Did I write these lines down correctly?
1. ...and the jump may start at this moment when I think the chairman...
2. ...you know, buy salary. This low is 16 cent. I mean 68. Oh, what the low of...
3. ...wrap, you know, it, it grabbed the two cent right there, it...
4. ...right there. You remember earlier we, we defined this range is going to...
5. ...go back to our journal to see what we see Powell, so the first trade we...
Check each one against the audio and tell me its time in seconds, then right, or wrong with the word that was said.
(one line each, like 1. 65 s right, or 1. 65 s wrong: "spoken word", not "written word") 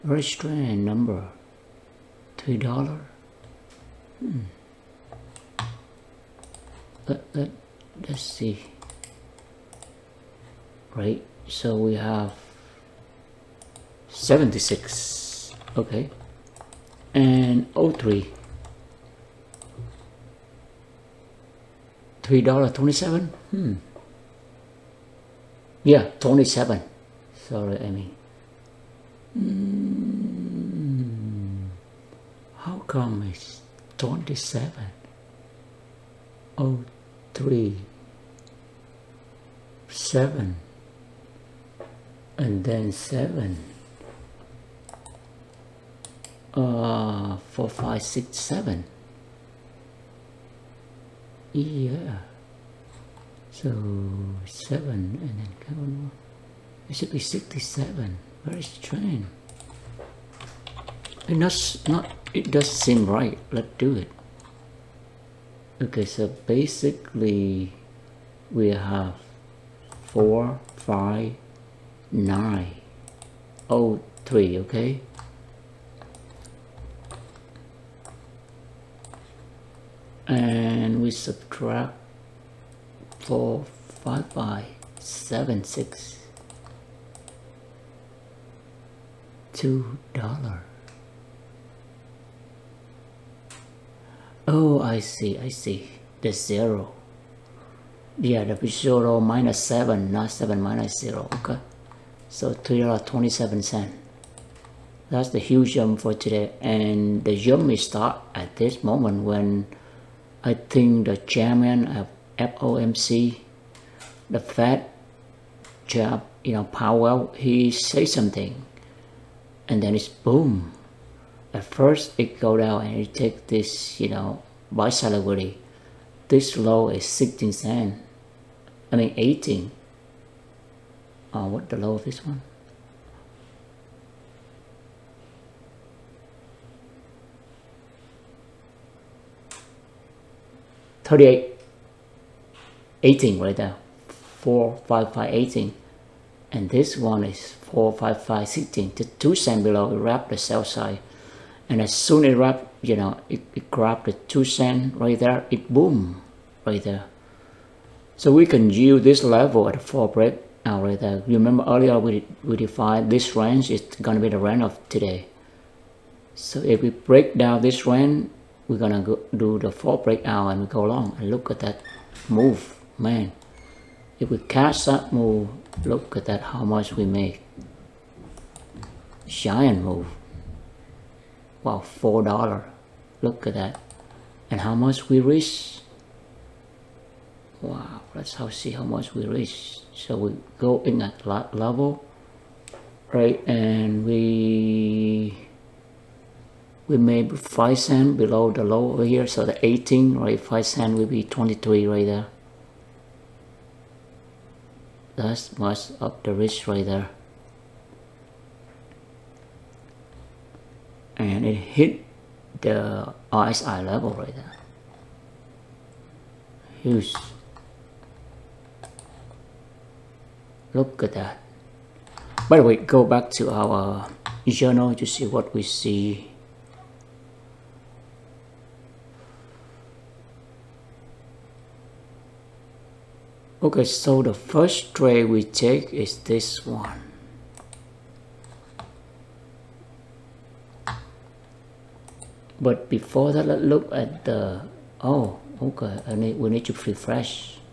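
1. 106 s right
2. 123 s wrong: "18", not "68"
3. 152 s right
4. 160 s right
5. 222 s wrong: "Okay", not "Powell".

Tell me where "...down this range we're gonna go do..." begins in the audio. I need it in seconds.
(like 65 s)
167 s.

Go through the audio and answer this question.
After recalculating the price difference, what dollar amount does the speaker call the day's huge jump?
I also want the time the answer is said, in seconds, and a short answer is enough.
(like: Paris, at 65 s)
$3.27, at 102 s.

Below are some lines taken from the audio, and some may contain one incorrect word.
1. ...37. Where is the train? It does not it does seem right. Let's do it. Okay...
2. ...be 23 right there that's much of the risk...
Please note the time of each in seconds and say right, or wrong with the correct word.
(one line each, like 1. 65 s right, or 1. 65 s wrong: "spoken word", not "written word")
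1. 57 s wrong: "67", not "37"
2. 201 s right.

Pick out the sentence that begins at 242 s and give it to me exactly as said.
But before that, let's look at the, oh, okay, I need, we need to refresh.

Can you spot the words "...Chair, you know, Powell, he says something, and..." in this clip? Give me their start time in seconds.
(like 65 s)
115 s.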